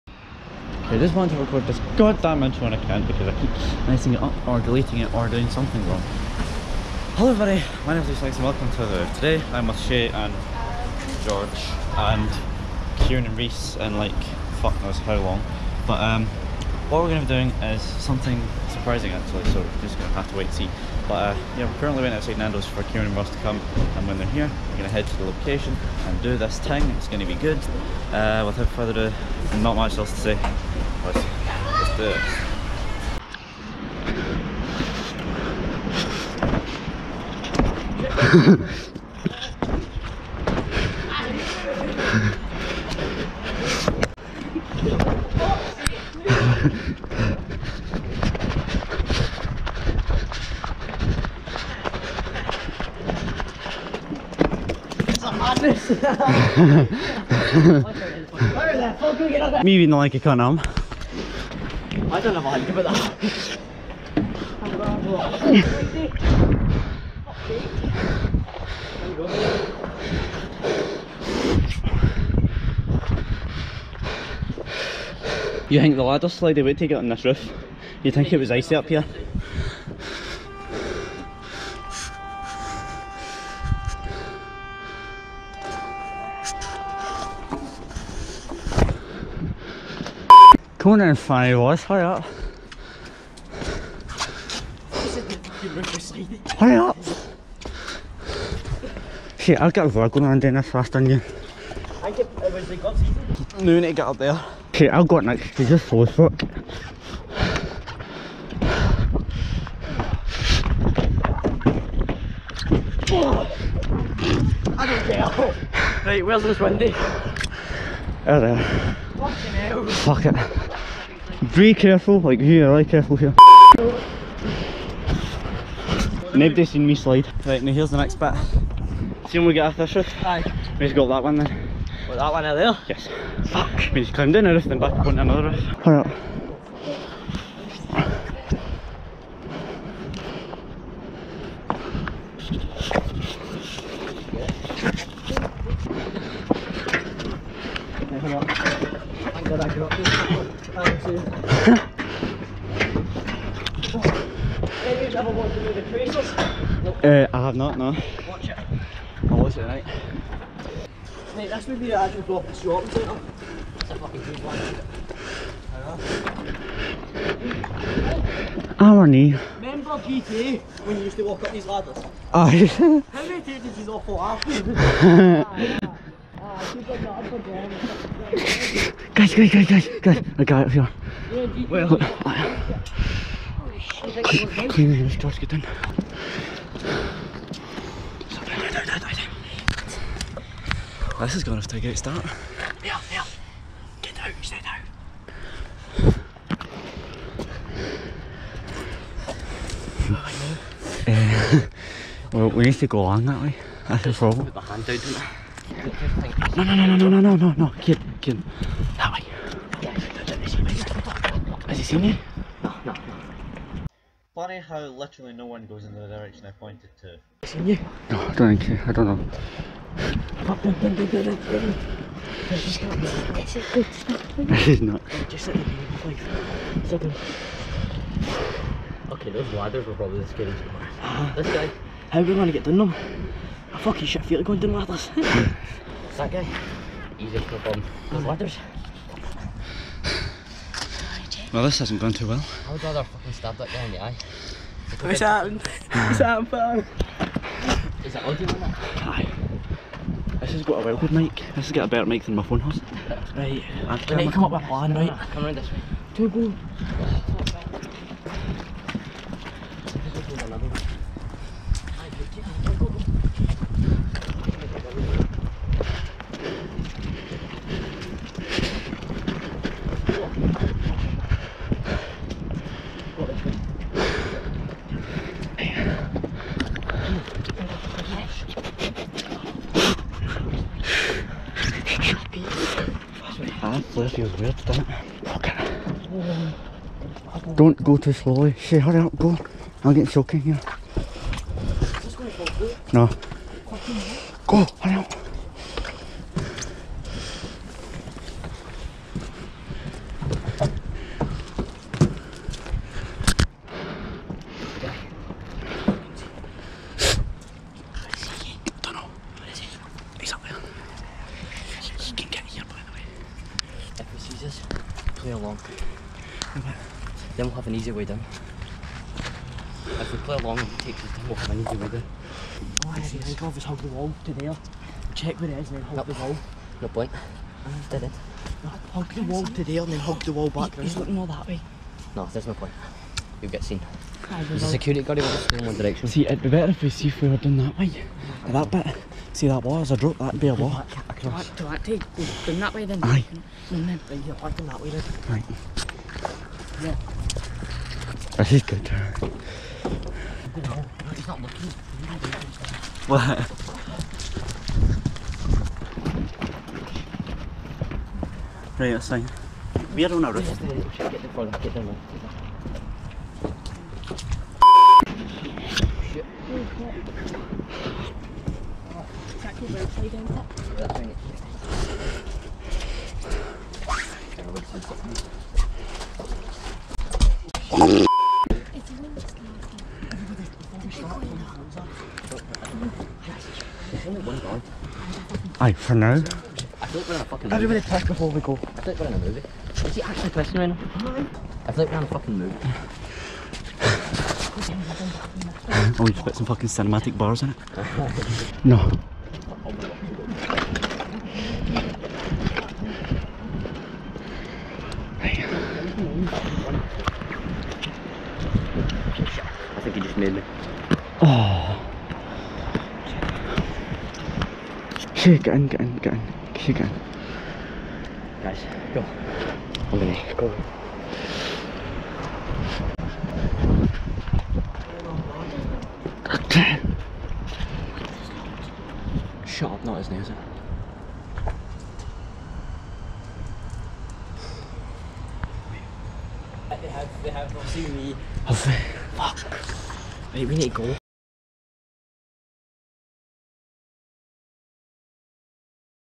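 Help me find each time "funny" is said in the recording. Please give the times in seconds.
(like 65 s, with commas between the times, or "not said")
91 s, 214 s.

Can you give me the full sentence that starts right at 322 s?
All I have to think of is hug the wall to there.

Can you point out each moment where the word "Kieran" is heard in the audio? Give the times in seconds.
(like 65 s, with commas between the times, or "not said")
13 s, 22 s.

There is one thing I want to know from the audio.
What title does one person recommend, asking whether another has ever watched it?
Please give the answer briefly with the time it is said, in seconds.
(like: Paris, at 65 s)
The Traces, at 155 s.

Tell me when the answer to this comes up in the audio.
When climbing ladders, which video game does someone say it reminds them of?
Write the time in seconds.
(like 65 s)
169 s.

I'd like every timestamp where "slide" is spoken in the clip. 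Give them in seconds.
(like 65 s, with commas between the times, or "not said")
76 s, 126 s.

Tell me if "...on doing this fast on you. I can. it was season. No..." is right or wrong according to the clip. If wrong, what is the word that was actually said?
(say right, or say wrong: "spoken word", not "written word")
right.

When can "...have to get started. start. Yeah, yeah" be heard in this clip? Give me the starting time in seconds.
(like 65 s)
191 s.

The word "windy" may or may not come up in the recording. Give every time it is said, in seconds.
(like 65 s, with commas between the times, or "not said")
116 s.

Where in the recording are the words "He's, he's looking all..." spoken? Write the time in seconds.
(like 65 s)
330 s.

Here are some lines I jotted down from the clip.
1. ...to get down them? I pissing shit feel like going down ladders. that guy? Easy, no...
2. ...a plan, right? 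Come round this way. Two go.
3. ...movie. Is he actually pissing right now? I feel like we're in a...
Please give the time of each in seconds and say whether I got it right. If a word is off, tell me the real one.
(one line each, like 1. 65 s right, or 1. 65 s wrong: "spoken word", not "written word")
1. 232 s wrong: "fucking", not "pissing"
2. 254 s right
3. 389 s right.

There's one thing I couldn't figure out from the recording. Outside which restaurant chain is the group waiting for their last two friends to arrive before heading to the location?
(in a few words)
Nando's.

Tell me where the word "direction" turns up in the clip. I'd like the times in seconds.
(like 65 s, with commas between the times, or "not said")
216 s, 335 s.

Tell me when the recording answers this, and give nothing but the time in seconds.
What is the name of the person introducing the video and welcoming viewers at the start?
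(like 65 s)
8 s.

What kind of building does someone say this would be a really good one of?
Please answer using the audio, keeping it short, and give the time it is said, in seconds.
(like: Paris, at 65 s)
Shopping centre, at 162 s.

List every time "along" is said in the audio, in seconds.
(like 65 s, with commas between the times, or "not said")
203 s, 315 s, 320 s.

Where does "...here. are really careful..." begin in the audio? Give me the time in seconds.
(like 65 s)
122 s.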